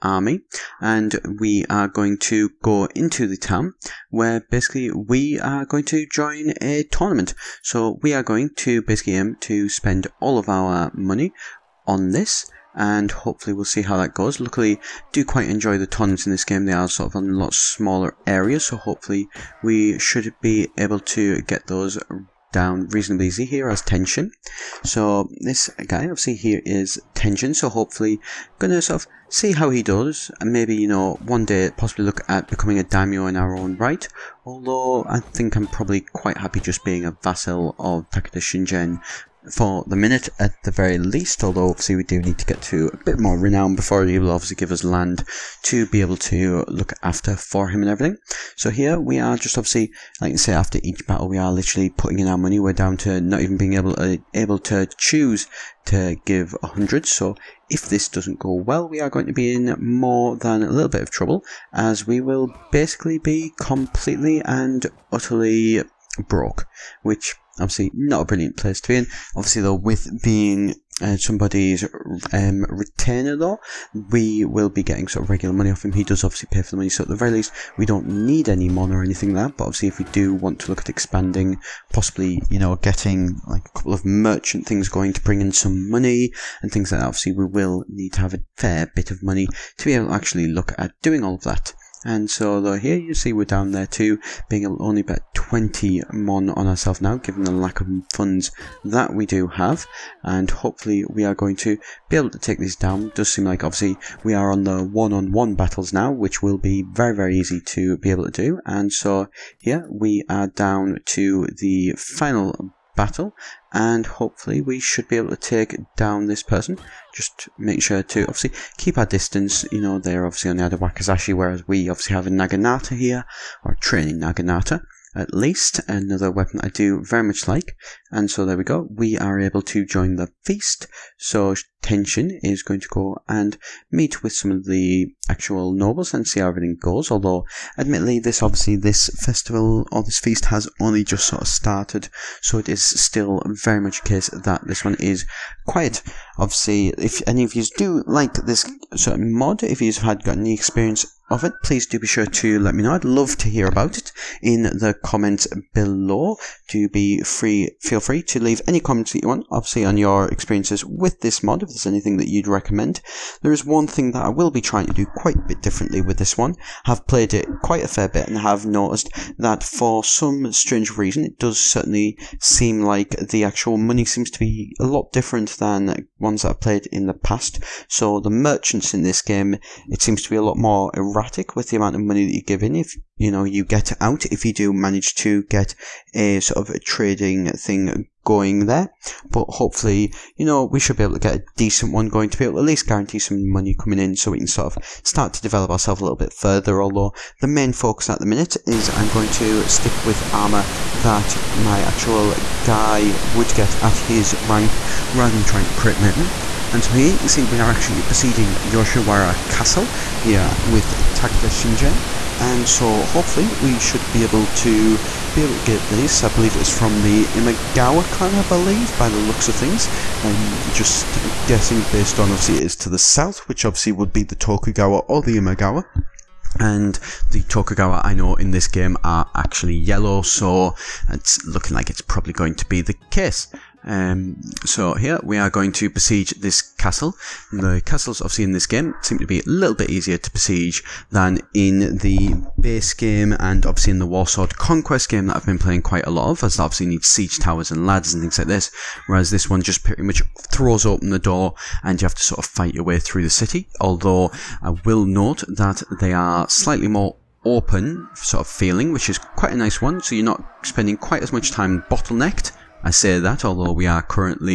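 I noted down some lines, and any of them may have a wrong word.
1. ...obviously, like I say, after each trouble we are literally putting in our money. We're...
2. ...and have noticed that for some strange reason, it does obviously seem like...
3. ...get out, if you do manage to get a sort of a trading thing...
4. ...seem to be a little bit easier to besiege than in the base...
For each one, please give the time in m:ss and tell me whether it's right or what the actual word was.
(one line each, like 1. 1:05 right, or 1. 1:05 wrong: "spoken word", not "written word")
1. 0:49 wrong: "battle", not "trouble"
2. 2:48 wrong: "certainly", not "obviously"
3. 3:03 right
4. 3:59 right.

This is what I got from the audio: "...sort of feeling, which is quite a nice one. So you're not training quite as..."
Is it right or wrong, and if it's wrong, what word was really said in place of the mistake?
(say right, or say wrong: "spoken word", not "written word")
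wrong: "spending", not "training".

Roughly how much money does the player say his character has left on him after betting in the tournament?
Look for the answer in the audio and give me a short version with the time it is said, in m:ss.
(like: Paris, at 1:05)
20 mon, at 1:35.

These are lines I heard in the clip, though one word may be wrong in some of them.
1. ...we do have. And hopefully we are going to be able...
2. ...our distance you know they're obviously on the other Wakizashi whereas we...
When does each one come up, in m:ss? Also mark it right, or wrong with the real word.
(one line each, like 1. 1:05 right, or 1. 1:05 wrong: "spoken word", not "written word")
1. 1:39 right
2. 1:58 right.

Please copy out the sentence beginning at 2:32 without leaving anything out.
I'd love to hear about it in the comments below.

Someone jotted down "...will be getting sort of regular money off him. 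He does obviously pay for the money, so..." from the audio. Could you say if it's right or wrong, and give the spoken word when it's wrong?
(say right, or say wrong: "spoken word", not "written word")
right.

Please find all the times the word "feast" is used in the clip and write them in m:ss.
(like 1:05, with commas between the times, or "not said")
2:10, 2:20.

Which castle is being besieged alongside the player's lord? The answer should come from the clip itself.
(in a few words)
Yoshiwara Castle.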